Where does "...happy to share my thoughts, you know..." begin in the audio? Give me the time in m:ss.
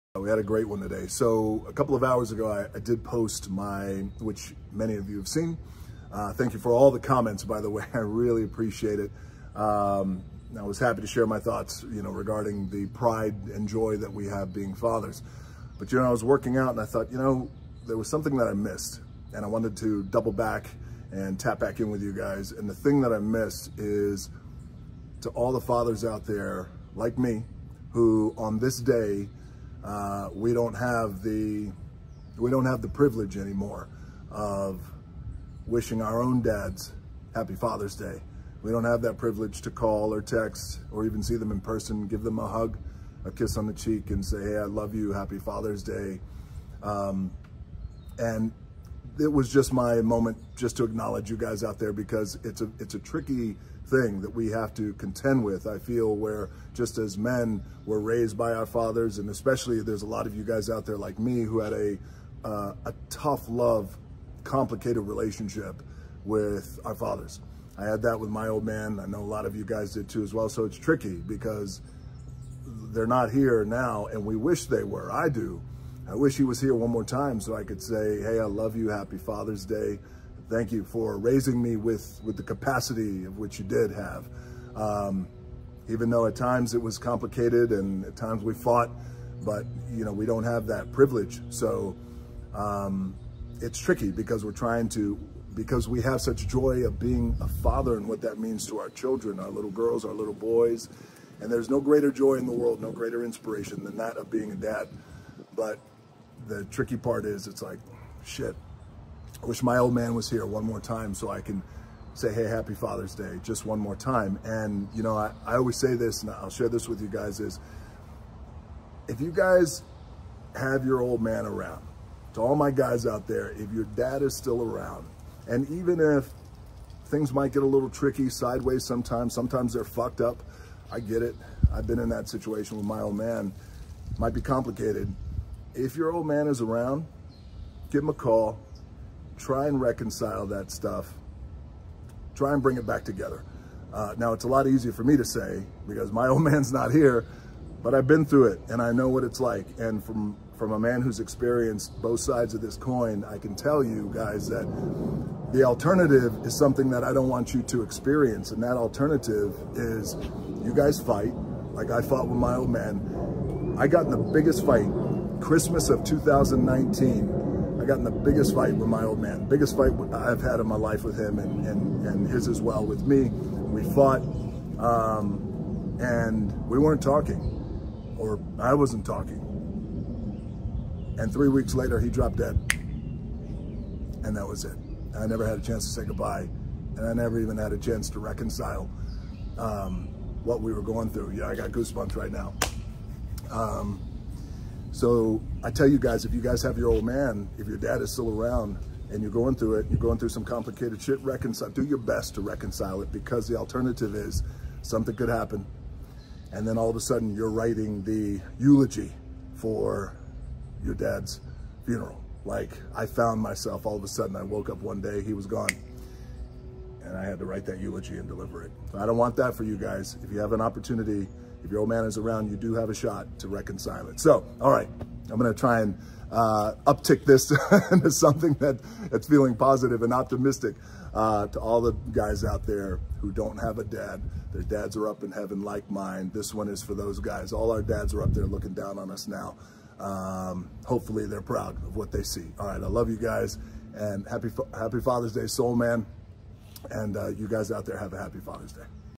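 0:10.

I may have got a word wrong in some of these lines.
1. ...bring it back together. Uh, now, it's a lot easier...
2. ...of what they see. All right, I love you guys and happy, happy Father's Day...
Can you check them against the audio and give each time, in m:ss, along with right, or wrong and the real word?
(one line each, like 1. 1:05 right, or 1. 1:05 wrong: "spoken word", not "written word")
1. 2:22 right
2. 4:01 right.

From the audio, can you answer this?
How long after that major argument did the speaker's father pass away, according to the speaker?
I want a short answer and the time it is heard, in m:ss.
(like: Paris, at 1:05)
3 weeks, at 3:01.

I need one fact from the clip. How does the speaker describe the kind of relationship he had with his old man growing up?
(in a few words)
Tough love.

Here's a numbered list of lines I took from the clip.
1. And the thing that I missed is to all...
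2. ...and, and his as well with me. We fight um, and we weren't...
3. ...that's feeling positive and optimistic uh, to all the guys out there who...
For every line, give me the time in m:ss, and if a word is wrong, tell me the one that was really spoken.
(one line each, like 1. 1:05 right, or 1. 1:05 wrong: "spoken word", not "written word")
1. 0:22 right
2. 2:51 wrong: "fought", not "fight"
3. 3:49 right.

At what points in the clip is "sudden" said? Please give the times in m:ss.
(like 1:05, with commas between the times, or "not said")
3:27, 3:34.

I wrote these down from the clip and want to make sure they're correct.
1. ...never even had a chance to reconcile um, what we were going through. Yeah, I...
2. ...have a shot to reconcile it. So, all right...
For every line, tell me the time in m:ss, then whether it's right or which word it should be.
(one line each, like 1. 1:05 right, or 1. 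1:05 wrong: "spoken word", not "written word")
1. 3:07 right
2. 3:42 right.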